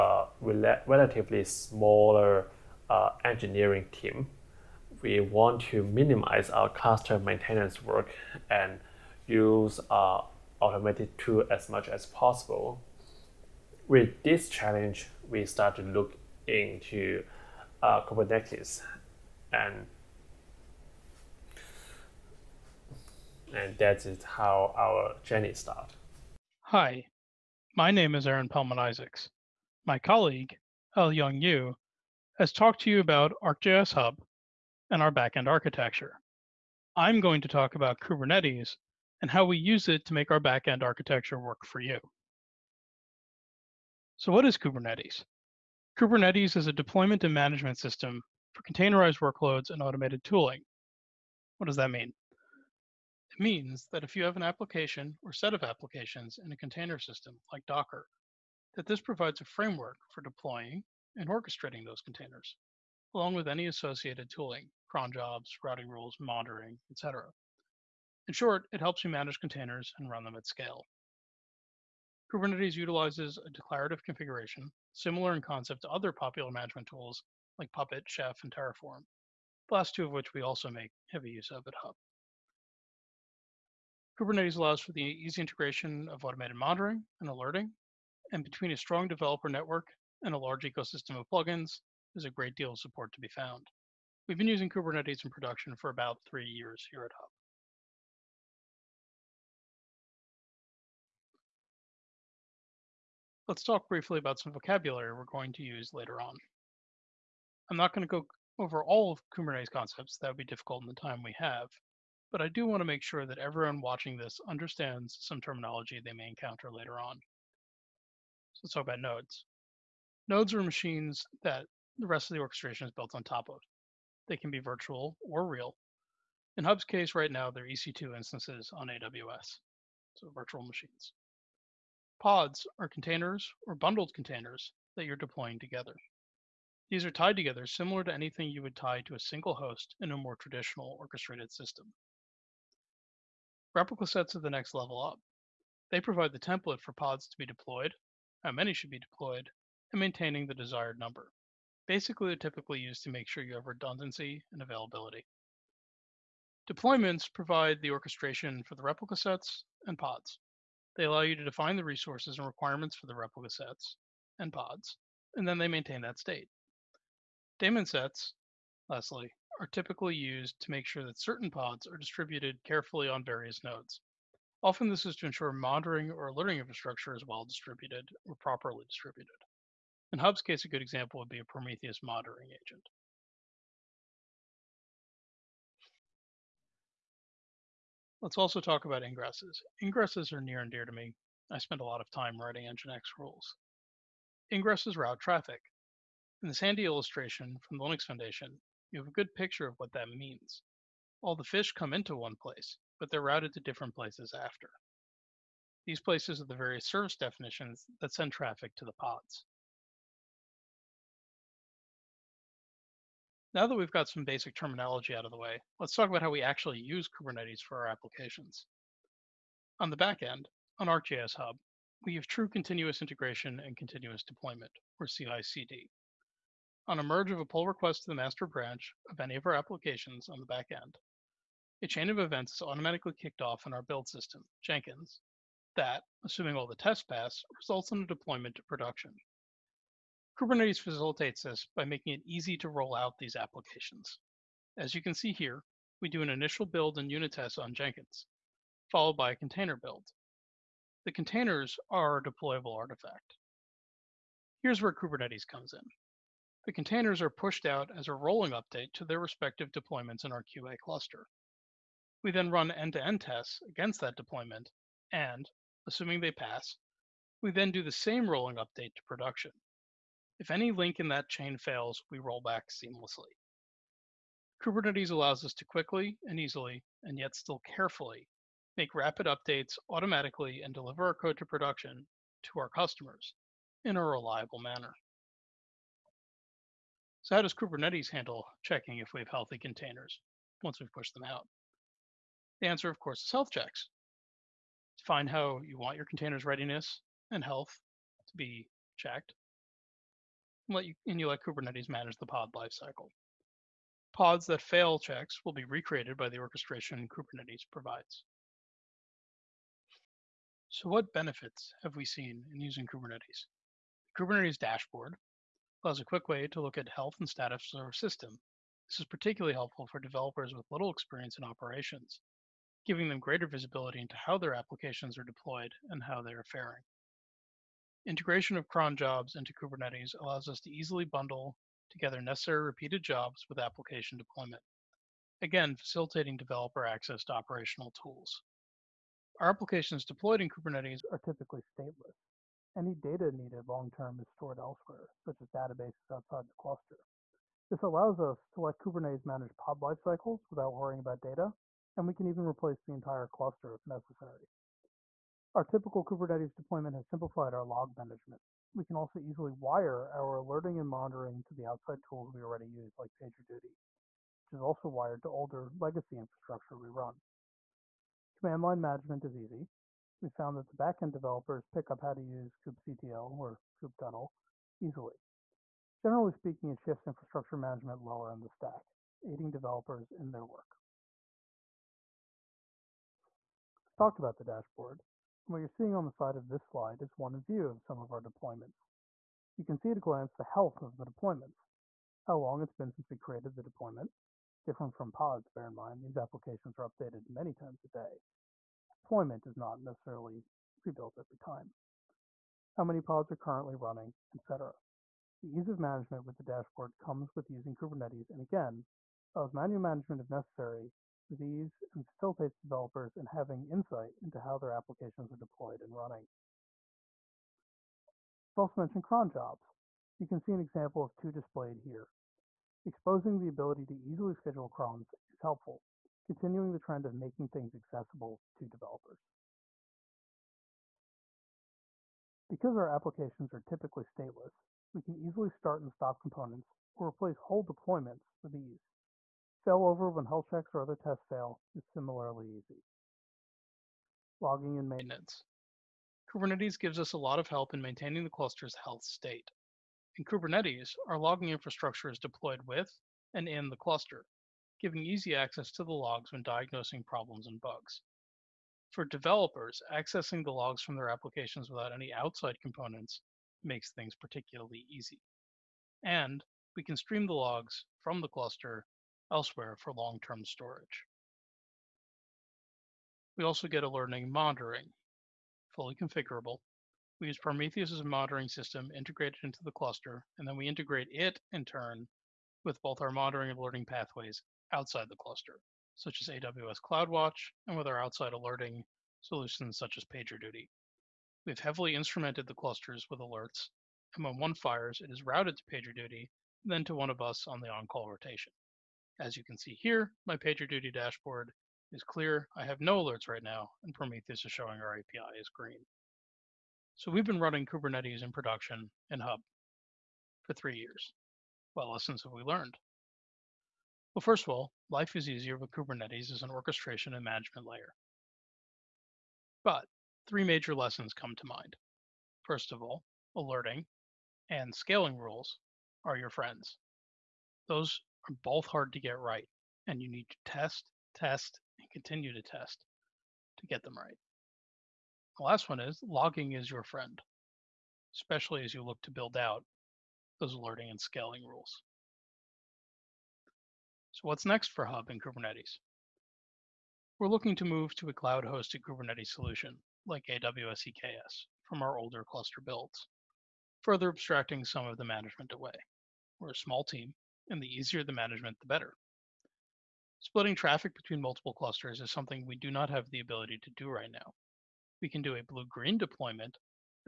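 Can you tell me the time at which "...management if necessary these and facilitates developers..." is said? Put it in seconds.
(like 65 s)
409 s.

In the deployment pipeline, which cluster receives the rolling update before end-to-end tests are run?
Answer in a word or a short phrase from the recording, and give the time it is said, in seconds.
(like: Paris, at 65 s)
QA cluster, at 260 s.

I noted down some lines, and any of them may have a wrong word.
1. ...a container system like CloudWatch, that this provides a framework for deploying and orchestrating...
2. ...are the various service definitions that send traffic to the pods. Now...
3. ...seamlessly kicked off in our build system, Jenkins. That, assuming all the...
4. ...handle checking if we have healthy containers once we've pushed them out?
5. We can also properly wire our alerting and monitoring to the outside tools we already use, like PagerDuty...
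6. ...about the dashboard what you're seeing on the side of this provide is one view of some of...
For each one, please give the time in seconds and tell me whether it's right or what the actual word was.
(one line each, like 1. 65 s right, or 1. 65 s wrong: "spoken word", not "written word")
1. 56 s wrong: "Docker", not "CloudWatch"
2. 206 s right
3. 232 s wrong: "automatically", not "seamlessly"
4. 288 s right
5. 358 s wrong: "easily", not "properly"
6. 384 s wrong: "slide", not "provide".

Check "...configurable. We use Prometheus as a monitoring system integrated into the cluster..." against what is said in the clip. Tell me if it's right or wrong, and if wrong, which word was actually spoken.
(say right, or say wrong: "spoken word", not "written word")
right.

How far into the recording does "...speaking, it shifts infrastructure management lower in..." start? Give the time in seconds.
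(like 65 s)
376 s.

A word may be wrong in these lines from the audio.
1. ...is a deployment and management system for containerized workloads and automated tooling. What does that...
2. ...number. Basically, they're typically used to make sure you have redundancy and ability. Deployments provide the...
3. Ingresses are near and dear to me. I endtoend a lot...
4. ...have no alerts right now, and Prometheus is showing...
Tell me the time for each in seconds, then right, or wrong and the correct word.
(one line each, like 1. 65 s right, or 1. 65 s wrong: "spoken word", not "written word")
1. 46 s right
2. 150 s wrong: "availability", not "ability"
3. 189 s wrong: "spend", not "endtoend"
4. 502 s right.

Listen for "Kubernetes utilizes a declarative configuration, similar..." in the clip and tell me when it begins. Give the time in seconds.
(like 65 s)
72 s.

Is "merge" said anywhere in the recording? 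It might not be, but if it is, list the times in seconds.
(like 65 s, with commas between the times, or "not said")
227 s.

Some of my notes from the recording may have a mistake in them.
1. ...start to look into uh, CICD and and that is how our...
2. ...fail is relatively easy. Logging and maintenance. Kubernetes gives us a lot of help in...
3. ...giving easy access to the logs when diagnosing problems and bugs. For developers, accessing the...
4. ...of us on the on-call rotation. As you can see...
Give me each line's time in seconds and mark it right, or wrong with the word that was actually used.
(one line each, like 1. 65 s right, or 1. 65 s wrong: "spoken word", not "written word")
1. 15 s wrong: "Kubernetes", not "CICD"
2. 441 s wrong: "similarly", not "relatively"
3. 454 s right
4. 497 s right.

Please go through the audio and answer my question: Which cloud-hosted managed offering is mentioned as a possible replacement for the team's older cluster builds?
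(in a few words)
AWS EKS.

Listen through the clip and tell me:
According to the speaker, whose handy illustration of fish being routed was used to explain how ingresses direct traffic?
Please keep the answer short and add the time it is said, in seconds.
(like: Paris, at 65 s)
the Linux Foundation, at 197 s.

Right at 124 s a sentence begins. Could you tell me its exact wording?
They can be virtual or real.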